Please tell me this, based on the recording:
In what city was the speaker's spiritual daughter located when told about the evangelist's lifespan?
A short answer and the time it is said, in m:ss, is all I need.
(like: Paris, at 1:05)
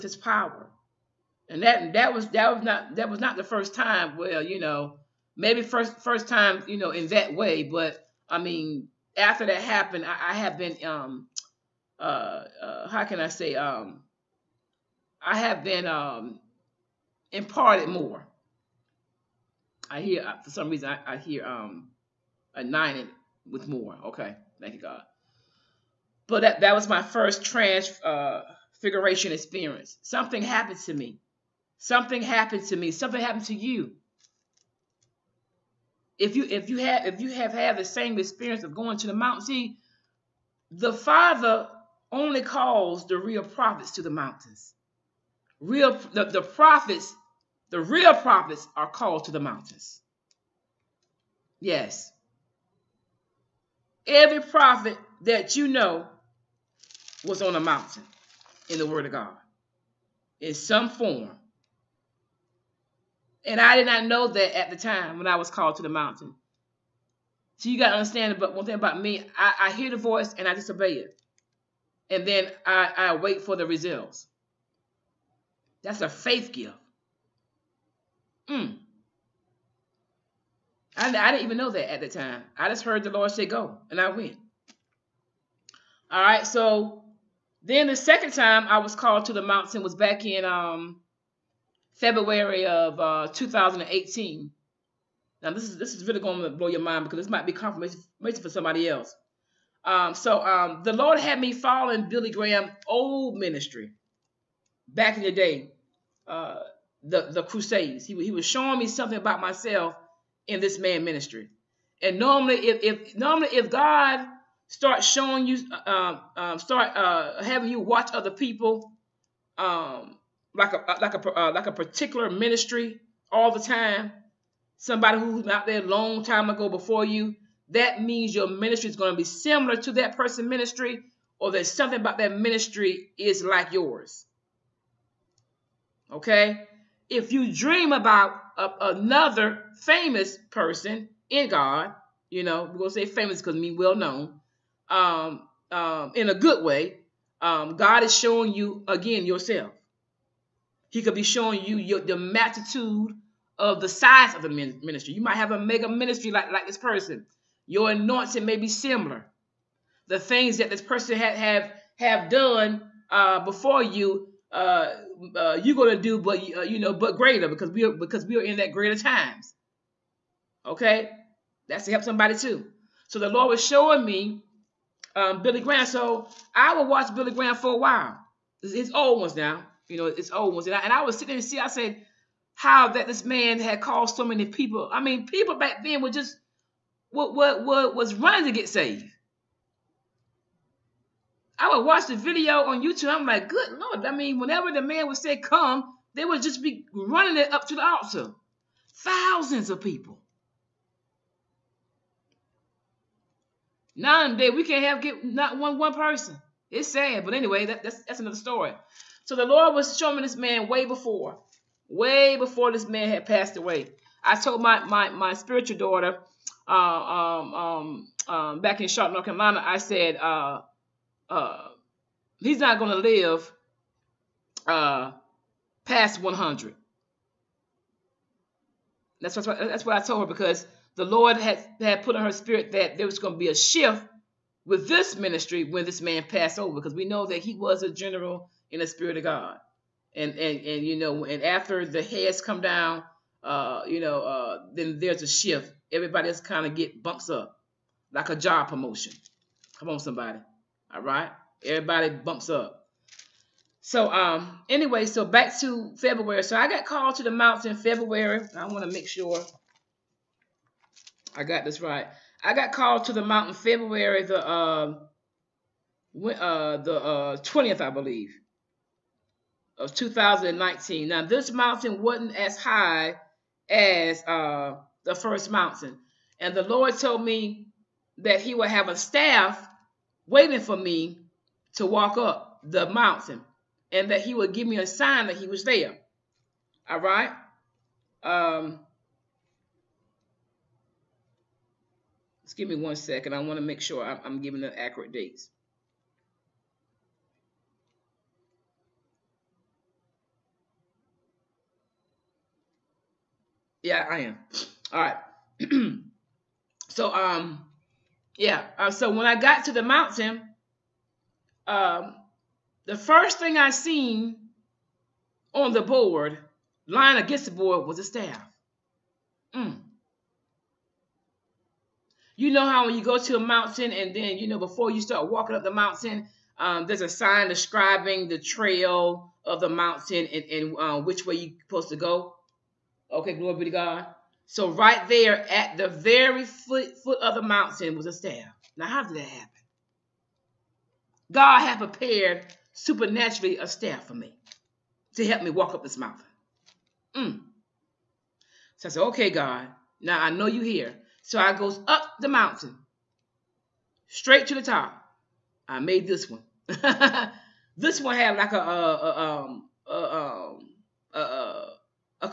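Charlotte, North Carolina, at 3:38.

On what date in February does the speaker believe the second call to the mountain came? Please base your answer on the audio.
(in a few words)
20th.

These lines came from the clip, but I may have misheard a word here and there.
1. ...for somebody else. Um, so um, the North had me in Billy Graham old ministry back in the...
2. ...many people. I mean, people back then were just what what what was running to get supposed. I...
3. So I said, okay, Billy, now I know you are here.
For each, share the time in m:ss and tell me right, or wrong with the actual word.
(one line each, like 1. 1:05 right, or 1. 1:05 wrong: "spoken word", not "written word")
1. 1:38 wrong: "Lord", not "North"
2. 3:04 wrong: "saved", not "supposed"
3. 5:48 wrong: "God", not "Billy".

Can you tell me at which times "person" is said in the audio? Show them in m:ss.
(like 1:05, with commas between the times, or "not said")
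2:10, 2:20, 2:36, 2:40, 3:25.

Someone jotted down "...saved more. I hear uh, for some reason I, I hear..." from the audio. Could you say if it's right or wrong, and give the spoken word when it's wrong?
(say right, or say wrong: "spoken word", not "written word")
wrong: "imparted", not "saved".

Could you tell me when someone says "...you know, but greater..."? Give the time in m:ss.
2:46.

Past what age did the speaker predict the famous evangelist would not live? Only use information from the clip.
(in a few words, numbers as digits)
100.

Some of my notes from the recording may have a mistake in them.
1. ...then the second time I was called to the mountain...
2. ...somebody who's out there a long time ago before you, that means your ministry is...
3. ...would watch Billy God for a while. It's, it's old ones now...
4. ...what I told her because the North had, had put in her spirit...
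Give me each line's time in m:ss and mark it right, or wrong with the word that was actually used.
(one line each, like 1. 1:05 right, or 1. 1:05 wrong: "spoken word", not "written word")
1. 1:27 right
2. 2:04 right
3. 2:56 wrong: "Graham", not "God"
4. 3:49 wrong: "Lord", not "North".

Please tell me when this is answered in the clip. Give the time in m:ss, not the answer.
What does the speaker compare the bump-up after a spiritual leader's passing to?
4:08.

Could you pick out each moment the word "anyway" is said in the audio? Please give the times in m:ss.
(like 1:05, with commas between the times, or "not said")
3:27, 4:14.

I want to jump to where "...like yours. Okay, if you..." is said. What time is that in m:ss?
2:13.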